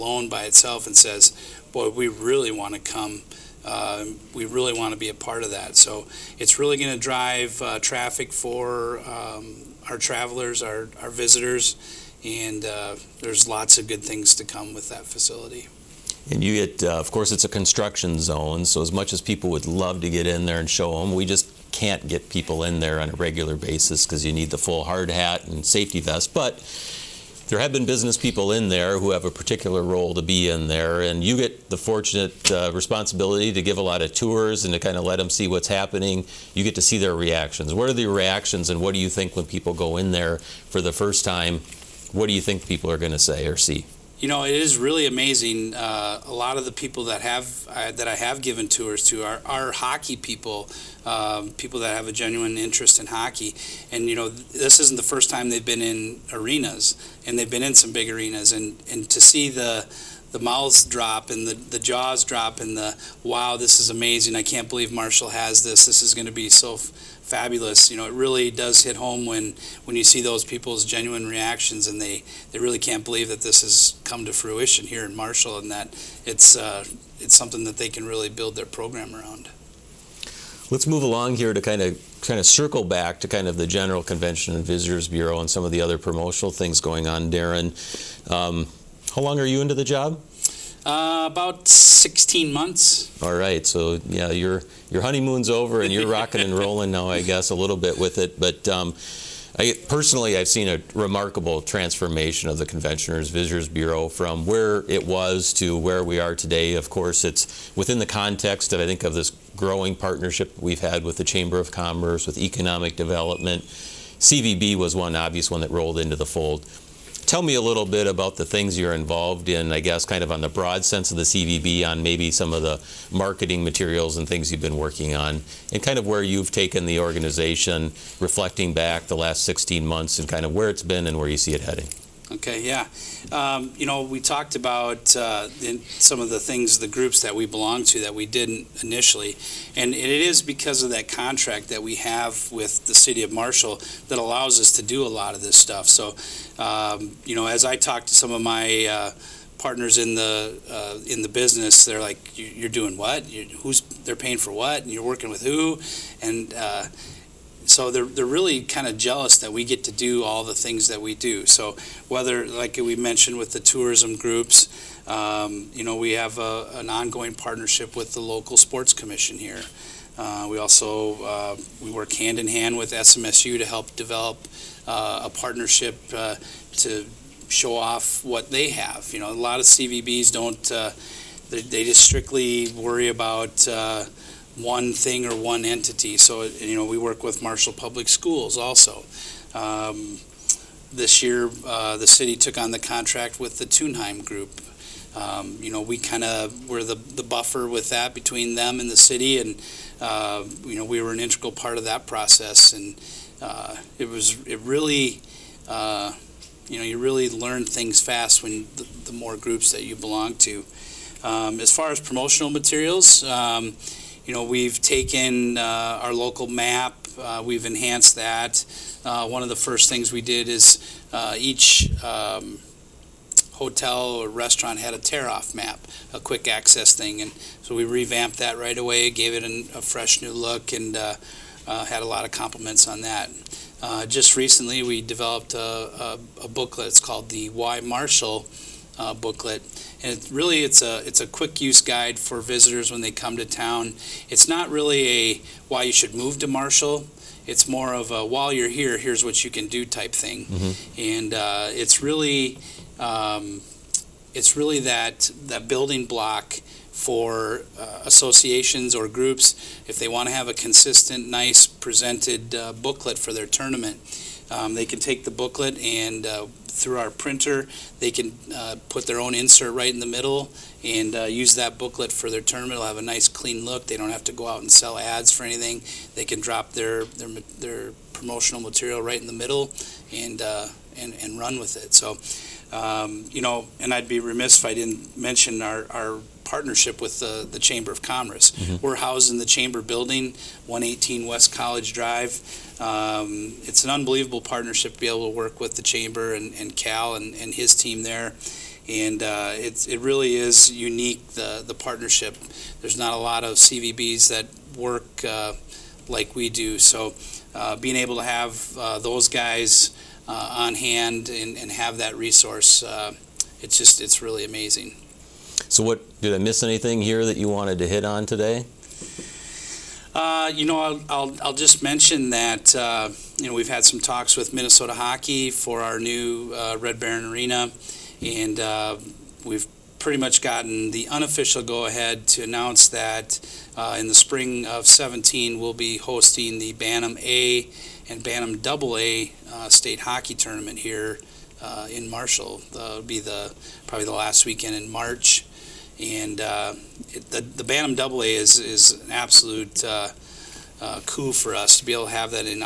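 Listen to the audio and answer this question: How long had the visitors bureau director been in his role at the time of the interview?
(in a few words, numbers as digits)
16 months.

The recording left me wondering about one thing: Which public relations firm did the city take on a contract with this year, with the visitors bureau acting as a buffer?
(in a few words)
Tunheim Group.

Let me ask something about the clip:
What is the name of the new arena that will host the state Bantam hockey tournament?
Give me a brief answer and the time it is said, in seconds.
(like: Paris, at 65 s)
Red Baron Arena, at 326 s.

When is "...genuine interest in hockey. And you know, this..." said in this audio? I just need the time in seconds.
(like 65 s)
52 s.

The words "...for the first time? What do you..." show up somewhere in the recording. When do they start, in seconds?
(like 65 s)
40 s.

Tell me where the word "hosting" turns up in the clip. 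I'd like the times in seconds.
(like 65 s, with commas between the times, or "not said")
335 s.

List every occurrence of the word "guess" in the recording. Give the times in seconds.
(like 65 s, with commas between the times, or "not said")
97 s, 119 s.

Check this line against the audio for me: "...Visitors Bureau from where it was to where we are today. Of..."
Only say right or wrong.
right.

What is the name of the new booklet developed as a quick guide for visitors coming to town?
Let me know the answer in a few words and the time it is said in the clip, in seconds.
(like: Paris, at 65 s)
Why Marshall, at 237 s.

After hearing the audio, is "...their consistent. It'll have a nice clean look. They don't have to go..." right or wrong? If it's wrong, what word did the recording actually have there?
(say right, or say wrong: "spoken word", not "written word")
wrong: "tournament", not "consistent".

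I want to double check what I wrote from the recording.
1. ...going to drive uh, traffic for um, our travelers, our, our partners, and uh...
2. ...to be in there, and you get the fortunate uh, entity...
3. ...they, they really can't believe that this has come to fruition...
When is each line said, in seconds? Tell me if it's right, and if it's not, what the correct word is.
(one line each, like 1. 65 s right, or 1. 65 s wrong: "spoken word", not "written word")
1. 6 s wrong: "visitors", not "partners"
2. 30 s wrong: "responsibility", not "entity"
3. 72 s right.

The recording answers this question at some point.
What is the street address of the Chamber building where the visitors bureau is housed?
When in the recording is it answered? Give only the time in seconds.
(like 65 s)
290 s.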